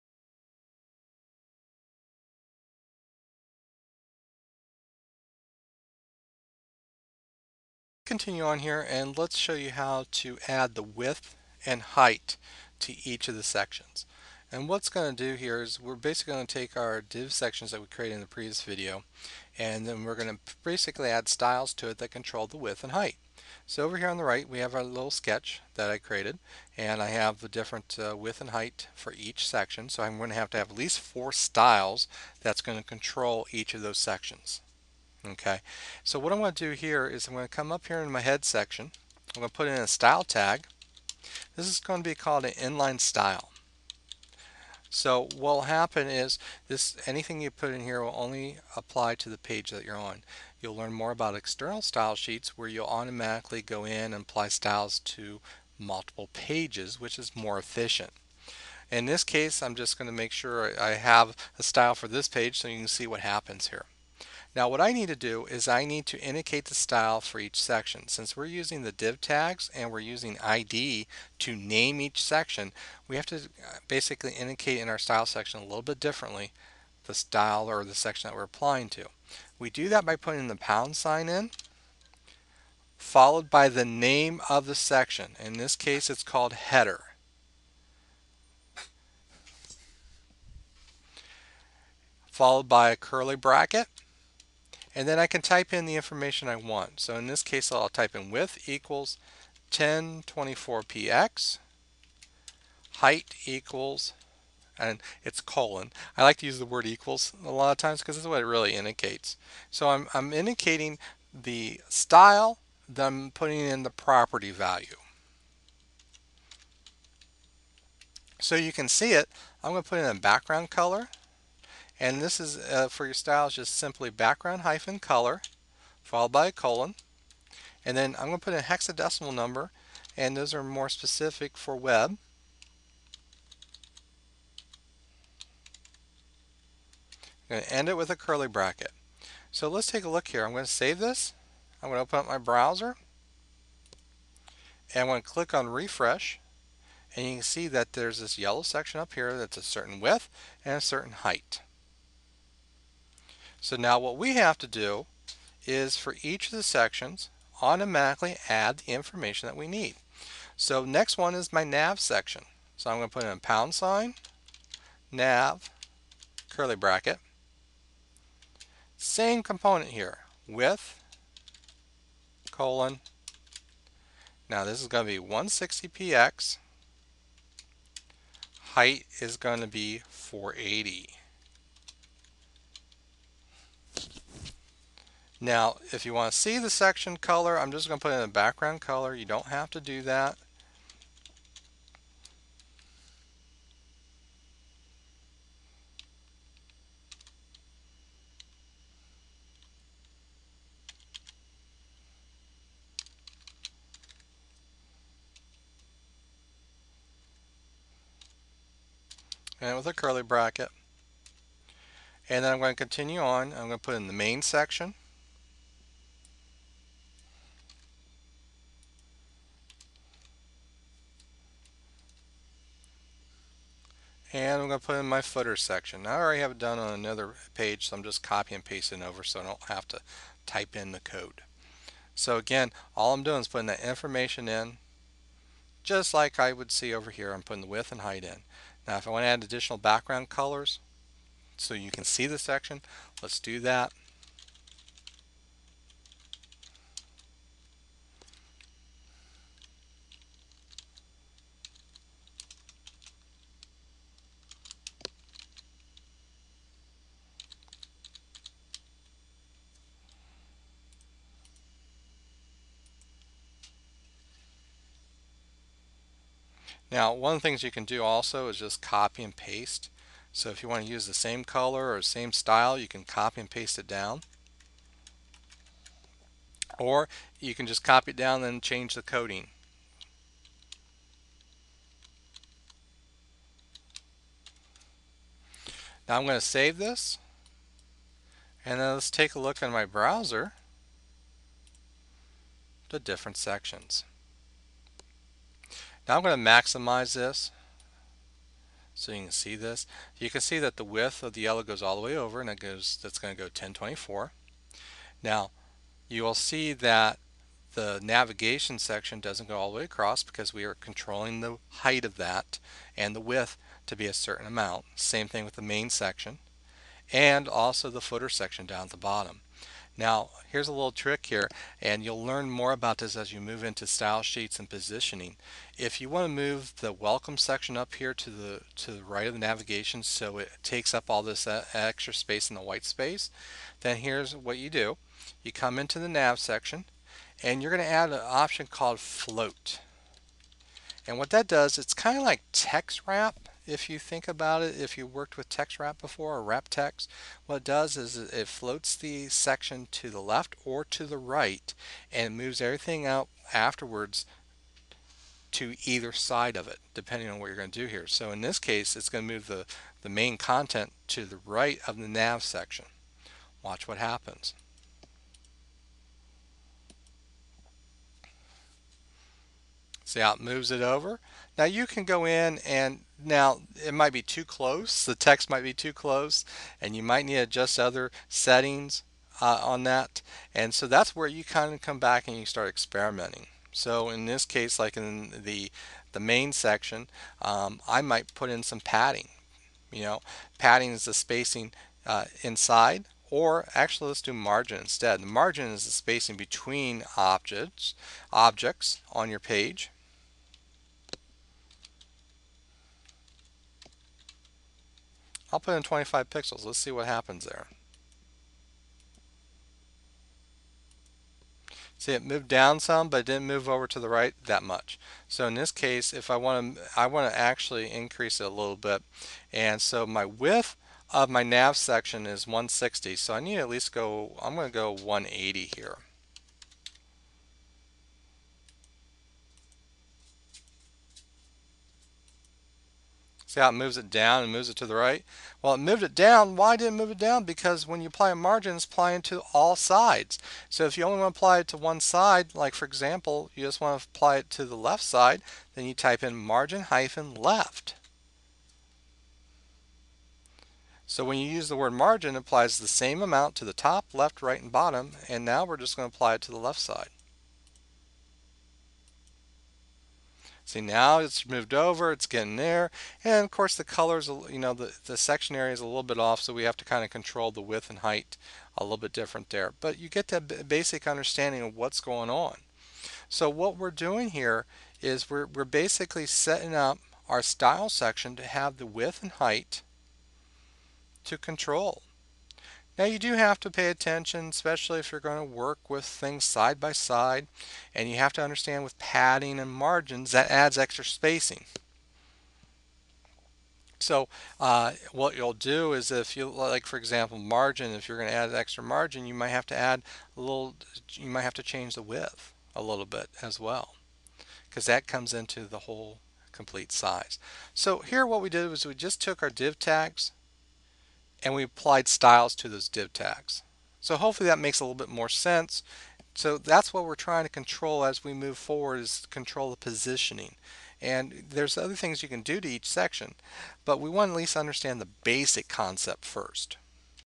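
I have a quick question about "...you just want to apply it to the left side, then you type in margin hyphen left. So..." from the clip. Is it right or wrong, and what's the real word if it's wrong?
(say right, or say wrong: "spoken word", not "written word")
right.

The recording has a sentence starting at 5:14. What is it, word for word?
Same thing with the main section and also the footer section down at the bottom.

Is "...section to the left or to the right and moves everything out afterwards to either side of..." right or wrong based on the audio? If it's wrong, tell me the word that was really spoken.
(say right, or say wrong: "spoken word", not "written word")
right.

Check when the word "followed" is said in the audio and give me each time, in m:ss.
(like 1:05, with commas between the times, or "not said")
1:22, 1:32, 2:06.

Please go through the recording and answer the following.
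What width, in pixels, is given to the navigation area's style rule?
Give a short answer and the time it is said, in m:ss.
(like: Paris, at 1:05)
160px, at 2:55.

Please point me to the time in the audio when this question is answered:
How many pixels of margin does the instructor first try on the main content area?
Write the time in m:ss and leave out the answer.
6:45.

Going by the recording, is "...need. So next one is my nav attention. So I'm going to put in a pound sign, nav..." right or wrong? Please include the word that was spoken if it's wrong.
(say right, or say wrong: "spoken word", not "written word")
wrong: "section", not "attention".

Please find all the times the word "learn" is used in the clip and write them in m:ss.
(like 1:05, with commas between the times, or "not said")
0:50, 5:22.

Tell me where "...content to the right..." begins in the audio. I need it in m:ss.
6:00.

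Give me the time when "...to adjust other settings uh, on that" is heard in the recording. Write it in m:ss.
6:17.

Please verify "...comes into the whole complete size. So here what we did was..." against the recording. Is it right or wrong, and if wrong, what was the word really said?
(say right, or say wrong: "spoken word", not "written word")
right.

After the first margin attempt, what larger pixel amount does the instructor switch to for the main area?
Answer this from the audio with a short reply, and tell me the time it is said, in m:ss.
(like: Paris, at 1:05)
180, at 7:04.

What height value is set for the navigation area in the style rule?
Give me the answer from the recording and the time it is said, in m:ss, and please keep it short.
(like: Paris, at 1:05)
480, at 3:00.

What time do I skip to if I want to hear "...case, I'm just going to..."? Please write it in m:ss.
0:59.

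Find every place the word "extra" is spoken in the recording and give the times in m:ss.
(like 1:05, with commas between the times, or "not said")
5:31, 8:10, 8:18.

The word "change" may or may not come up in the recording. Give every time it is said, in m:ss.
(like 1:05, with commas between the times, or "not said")
4:38, 8:21.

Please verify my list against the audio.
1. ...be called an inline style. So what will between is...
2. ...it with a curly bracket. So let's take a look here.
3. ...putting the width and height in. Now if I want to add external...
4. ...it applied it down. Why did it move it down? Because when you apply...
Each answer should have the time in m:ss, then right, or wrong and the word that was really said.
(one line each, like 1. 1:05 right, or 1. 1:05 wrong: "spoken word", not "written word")
1. 0:42 wrong: "happen", not "between"
2. 2:17 right
3. 3:57 wrong: "additional", not "external"
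4. 7:15 wrong: "moved", not "applied".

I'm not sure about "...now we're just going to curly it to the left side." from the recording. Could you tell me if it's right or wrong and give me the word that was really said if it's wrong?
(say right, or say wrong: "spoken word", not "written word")
wrong: "apply", not "curly".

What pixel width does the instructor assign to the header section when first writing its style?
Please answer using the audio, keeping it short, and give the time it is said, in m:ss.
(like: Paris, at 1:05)
1024px, at 1:39.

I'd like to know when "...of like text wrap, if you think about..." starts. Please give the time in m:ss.
5:42.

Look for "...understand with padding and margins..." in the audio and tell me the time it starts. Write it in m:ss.
8:08.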